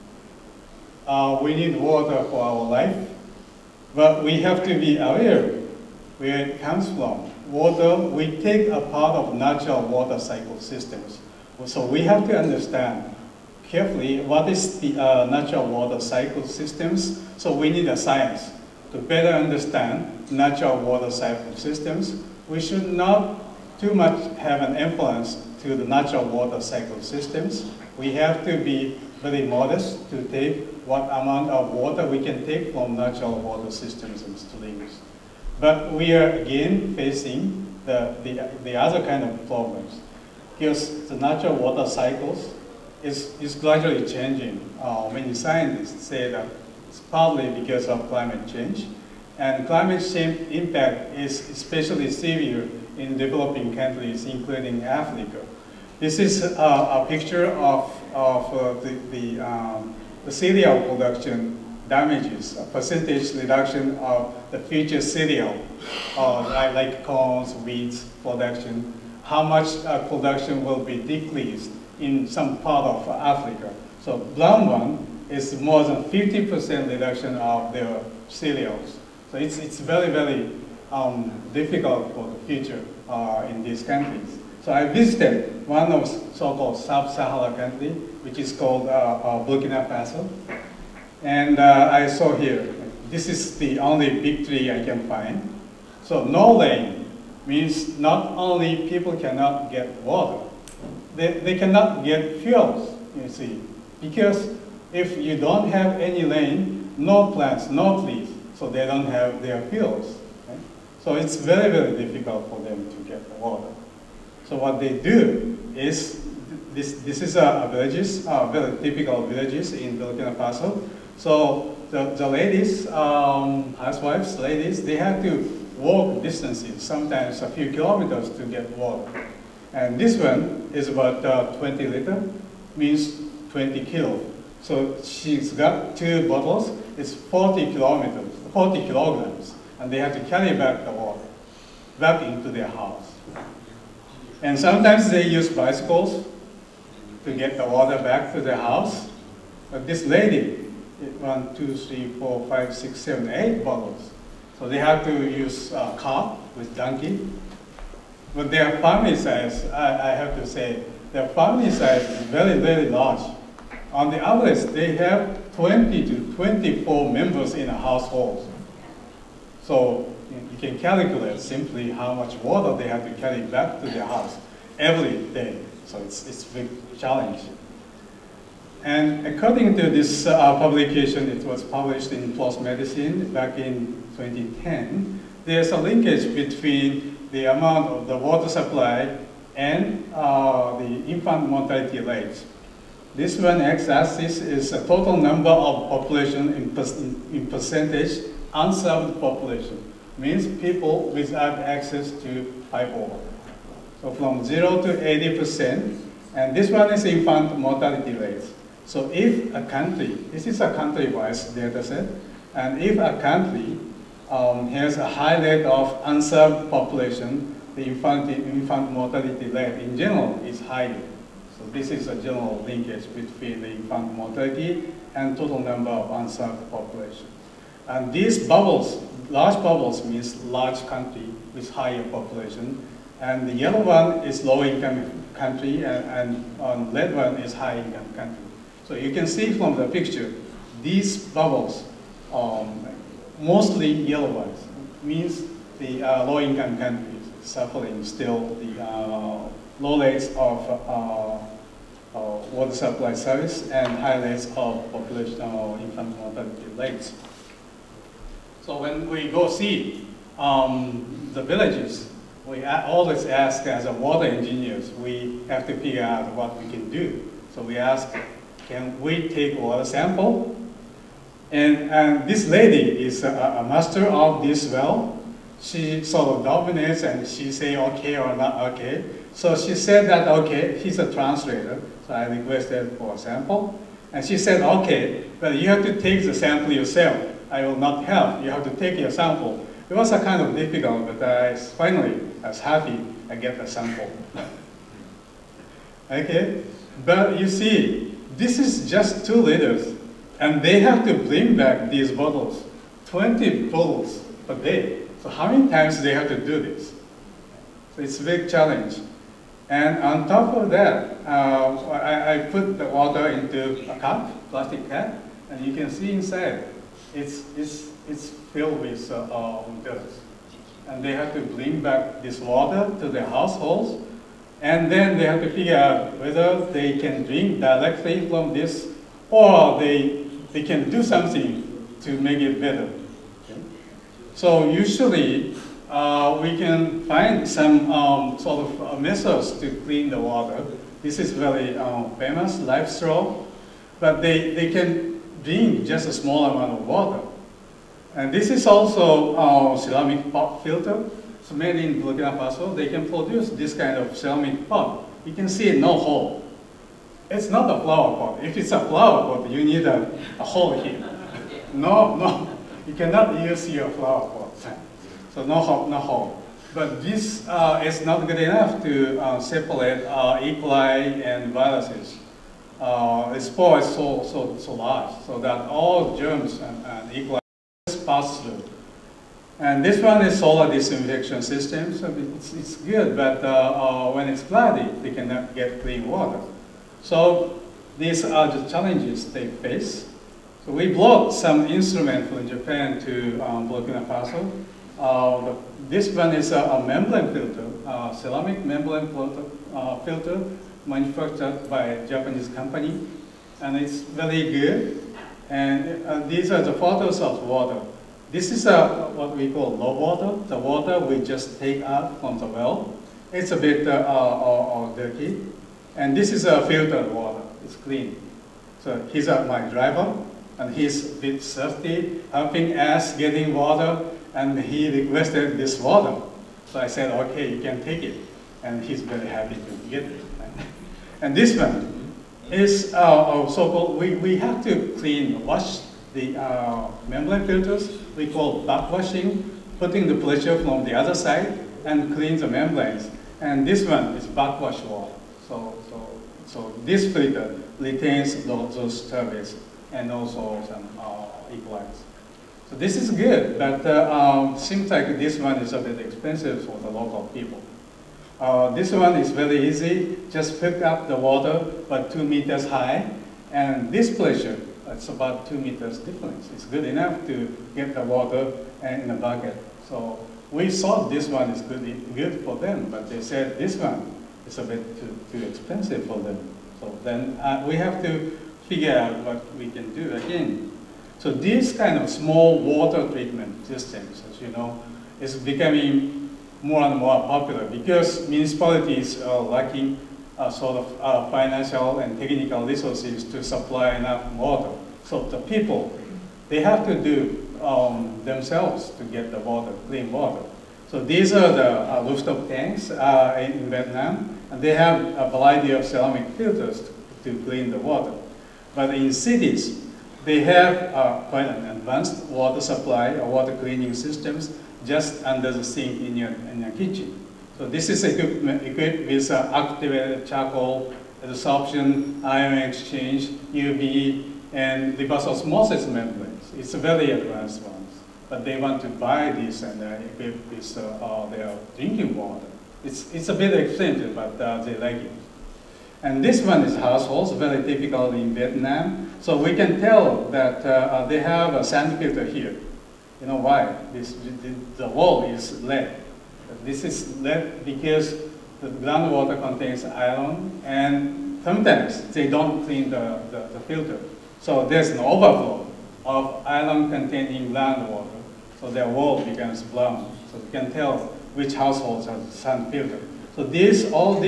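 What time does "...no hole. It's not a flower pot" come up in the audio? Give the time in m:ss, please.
5:55.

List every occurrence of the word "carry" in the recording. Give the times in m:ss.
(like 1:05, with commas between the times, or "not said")
2:20, 2:53.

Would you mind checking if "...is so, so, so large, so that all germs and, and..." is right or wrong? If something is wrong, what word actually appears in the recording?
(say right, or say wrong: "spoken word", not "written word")
right.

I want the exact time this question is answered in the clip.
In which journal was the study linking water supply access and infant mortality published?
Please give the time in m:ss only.
3:02.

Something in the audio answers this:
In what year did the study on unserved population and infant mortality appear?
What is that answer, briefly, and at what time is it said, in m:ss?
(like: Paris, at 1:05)
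2010, at 3:04.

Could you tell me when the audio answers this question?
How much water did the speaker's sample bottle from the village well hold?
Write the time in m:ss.
4:59.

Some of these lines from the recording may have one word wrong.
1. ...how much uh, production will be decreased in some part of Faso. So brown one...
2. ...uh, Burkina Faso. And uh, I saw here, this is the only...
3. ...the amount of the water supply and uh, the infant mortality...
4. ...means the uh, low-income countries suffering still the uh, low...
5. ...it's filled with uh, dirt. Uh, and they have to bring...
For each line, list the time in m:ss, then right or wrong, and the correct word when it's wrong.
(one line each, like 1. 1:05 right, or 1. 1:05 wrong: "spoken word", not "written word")
1. 1:09 wrong: "Africa", not "Faso"
2. 1:29 right
3. 3:07 right
4. 4:05 right
5. 5:18 right.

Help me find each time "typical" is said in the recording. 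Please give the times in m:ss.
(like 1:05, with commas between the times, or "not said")
1:58, 8:57.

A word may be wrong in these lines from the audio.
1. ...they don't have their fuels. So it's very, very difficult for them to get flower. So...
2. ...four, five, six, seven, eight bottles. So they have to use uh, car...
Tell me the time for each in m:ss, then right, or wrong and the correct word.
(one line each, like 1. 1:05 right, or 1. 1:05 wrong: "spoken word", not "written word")
1. 1:48 wrong: "water", not "flower"
2. 2:32 right.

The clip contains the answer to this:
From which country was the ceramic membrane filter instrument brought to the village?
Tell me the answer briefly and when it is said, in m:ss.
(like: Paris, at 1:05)
Japan, at 6:32.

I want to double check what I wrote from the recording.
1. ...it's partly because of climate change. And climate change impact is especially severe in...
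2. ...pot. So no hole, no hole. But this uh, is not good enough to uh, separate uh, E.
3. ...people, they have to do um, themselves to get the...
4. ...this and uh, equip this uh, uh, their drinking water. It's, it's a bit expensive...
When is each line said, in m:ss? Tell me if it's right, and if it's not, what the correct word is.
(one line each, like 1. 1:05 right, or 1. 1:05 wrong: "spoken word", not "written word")
1. 0:46 right
2. 6:04 right
3. 8:15 right
4. 8:49 right.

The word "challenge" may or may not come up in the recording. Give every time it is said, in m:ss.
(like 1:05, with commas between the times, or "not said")
2:56, 5:08, 6:28.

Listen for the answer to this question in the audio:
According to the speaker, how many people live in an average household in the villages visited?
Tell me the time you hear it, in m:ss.
2:45.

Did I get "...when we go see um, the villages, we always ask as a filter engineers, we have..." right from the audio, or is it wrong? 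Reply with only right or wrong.
wrong.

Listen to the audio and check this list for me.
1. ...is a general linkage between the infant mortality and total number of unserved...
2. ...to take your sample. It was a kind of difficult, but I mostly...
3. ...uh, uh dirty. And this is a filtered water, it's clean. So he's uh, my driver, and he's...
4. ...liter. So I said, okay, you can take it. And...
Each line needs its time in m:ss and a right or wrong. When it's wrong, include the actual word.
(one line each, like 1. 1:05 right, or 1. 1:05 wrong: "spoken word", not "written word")
1. 3:41 right
2. 4:48 wrong: "finally", not "mostly"
3. 6:54 right
4. 7:05 wrong: "water", not "liter".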